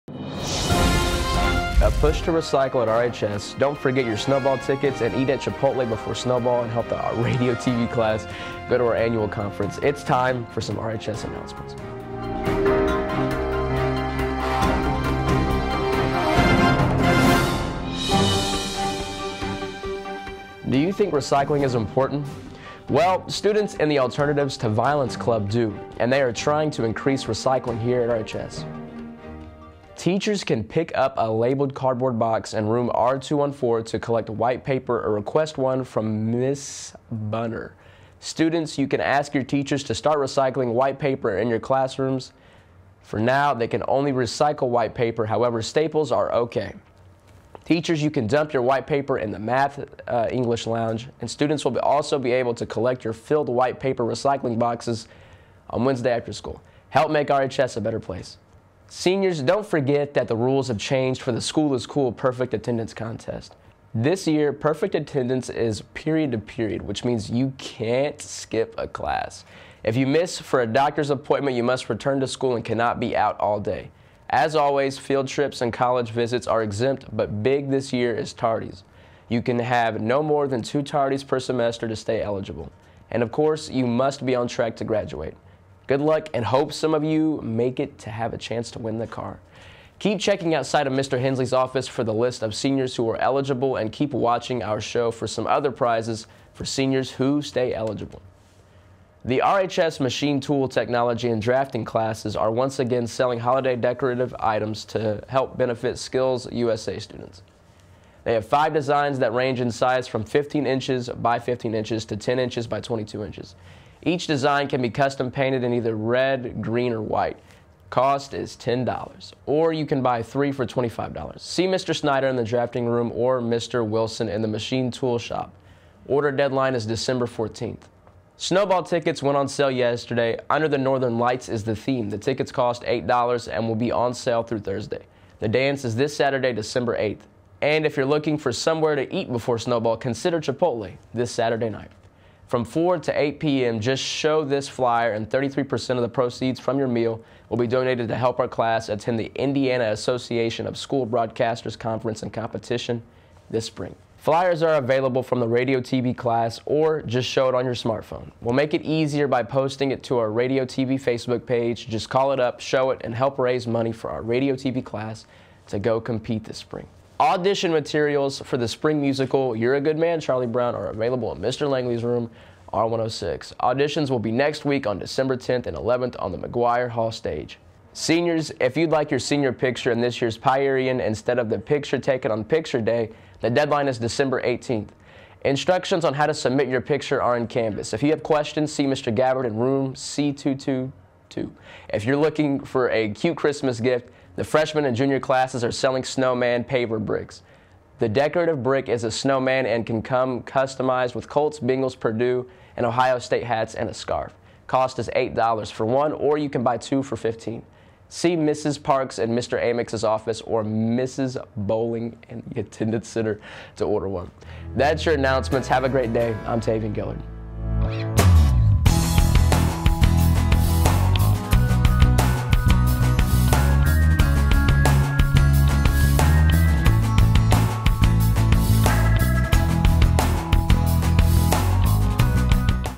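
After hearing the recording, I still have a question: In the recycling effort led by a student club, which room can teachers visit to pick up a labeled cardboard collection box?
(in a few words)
R214.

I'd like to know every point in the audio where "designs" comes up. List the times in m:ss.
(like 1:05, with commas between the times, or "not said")
1:48, 1:54.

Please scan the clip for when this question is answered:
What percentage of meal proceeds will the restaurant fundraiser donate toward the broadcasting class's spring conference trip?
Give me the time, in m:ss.
2:25.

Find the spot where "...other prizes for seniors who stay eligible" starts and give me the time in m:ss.
1:35.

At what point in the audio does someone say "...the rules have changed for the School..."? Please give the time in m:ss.
1:00.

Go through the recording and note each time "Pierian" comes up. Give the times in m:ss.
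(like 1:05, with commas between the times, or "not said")
3:00.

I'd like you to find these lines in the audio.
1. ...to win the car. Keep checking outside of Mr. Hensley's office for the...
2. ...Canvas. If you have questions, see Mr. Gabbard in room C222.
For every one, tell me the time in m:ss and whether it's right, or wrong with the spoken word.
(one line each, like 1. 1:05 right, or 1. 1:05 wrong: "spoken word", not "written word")
1. 1:28 right
2. 3:07 right.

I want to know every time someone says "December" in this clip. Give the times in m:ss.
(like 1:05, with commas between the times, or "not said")
2:06, 2:16, 2:54, 3:03.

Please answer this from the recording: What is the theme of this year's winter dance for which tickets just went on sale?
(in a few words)
Under the Northern Lights.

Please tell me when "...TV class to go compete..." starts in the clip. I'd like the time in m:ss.
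2:44.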